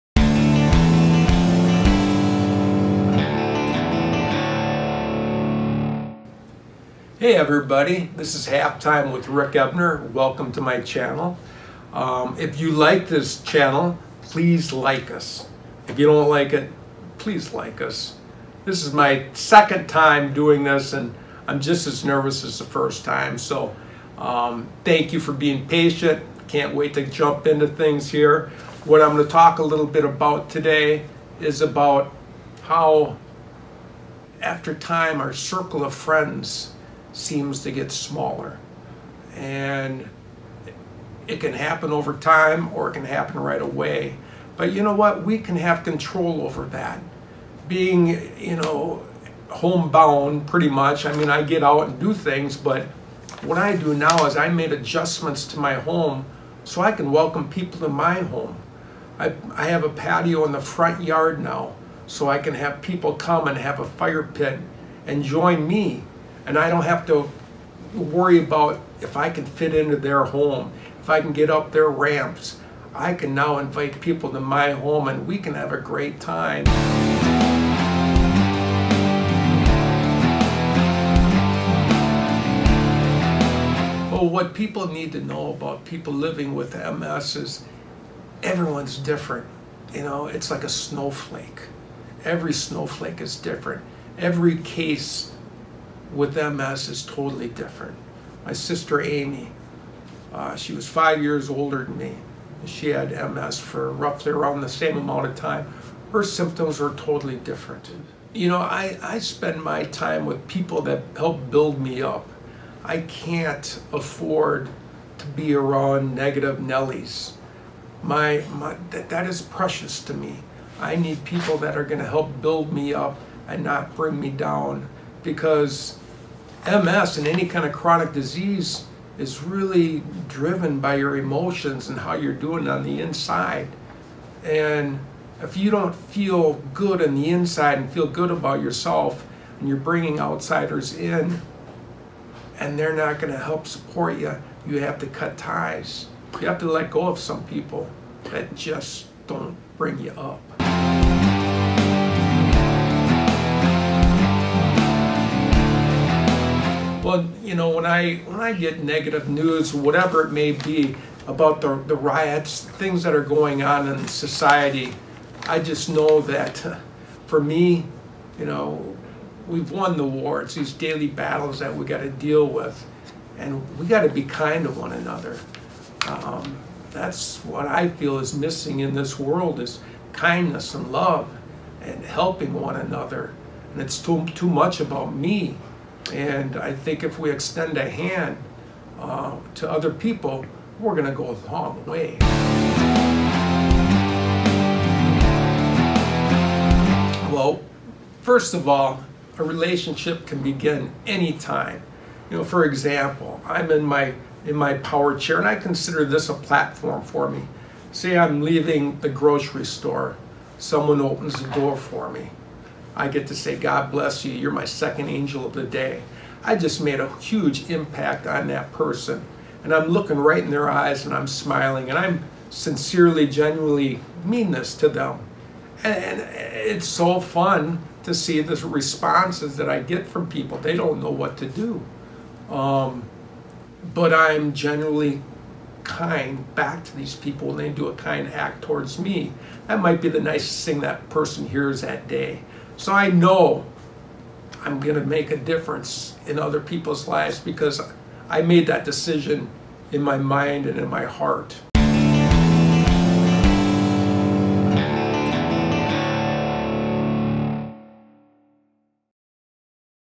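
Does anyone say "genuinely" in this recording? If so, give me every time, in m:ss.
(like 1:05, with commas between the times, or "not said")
3:43, 3:54.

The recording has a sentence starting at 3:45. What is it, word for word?
And it's so fun to see the responses that I get from people.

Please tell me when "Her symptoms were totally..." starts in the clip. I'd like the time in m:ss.
1:46.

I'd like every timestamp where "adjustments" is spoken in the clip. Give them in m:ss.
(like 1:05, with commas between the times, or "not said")
0:54.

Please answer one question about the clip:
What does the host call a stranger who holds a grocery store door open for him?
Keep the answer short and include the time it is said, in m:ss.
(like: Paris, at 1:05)
Second angel of the day, at 3:34.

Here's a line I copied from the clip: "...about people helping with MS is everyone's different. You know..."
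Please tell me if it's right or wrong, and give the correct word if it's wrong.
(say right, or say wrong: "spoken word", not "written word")
wrong: "living", not "helping".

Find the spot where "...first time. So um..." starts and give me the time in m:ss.
0:22.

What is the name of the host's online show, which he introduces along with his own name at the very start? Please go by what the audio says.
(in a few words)
Halftime.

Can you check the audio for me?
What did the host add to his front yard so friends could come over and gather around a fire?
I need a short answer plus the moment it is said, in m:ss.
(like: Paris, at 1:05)
A patio, at 0:59.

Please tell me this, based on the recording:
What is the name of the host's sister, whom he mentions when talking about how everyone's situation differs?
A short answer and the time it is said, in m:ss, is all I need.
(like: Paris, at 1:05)
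Amy, at 1:39.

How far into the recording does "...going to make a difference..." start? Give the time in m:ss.
4:04.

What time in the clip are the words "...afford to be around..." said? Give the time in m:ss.
1:53.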